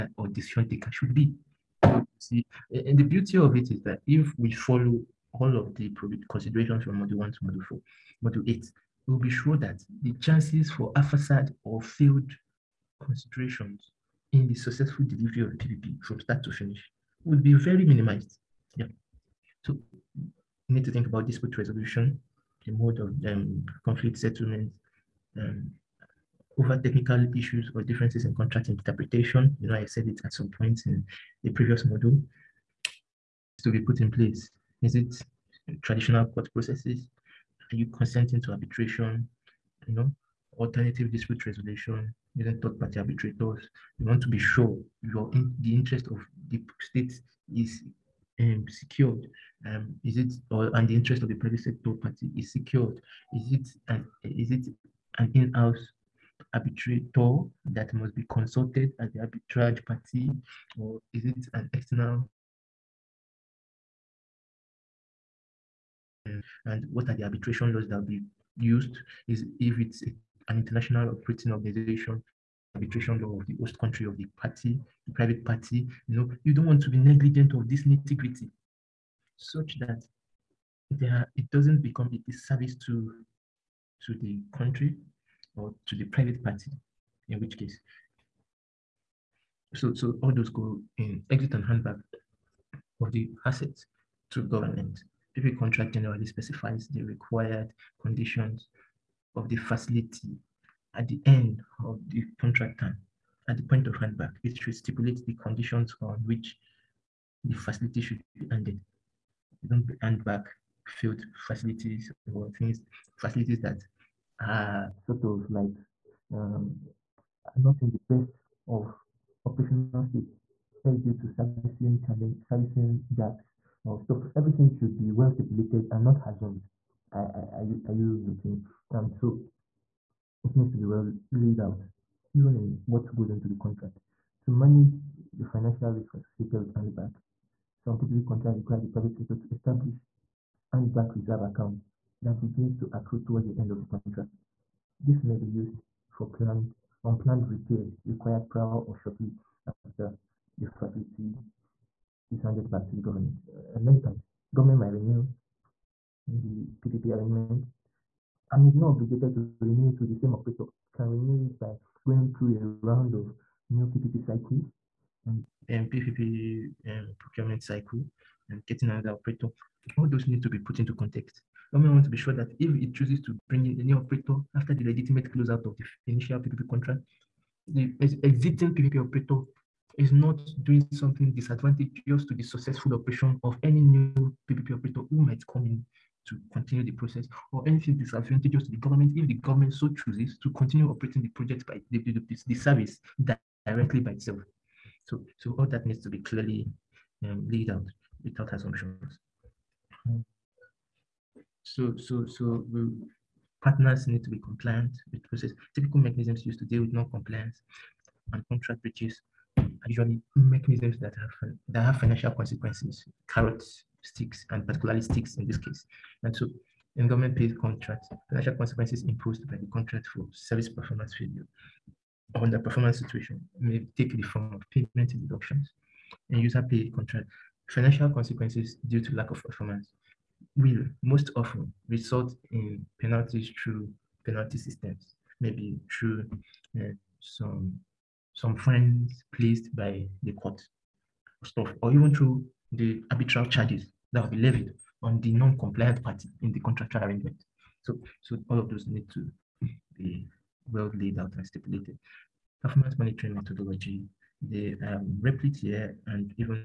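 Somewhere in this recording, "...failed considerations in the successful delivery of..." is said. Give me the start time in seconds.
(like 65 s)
11 s.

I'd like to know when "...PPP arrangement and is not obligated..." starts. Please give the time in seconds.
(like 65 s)
156 s.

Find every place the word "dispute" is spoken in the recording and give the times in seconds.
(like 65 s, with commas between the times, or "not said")
21 s, 41 s.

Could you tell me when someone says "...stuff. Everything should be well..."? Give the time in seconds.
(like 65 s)
123 s.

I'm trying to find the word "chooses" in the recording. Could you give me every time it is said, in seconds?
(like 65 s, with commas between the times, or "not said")
172 s, 189 s.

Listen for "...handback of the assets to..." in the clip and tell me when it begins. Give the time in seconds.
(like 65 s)
91 s.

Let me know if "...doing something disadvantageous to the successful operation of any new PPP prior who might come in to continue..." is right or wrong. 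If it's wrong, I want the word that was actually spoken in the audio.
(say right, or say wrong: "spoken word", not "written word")
wrong: "operator", not "prior".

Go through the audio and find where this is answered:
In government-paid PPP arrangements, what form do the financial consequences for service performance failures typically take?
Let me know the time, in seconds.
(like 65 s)
224 s.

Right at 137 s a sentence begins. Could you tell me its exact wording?
Some PPP contracts require the private sector to establish handback reserve account that begins to accrue towards the end of the contract.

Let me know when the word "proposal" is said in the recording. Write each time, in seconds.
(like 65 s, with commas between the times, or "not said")
not said.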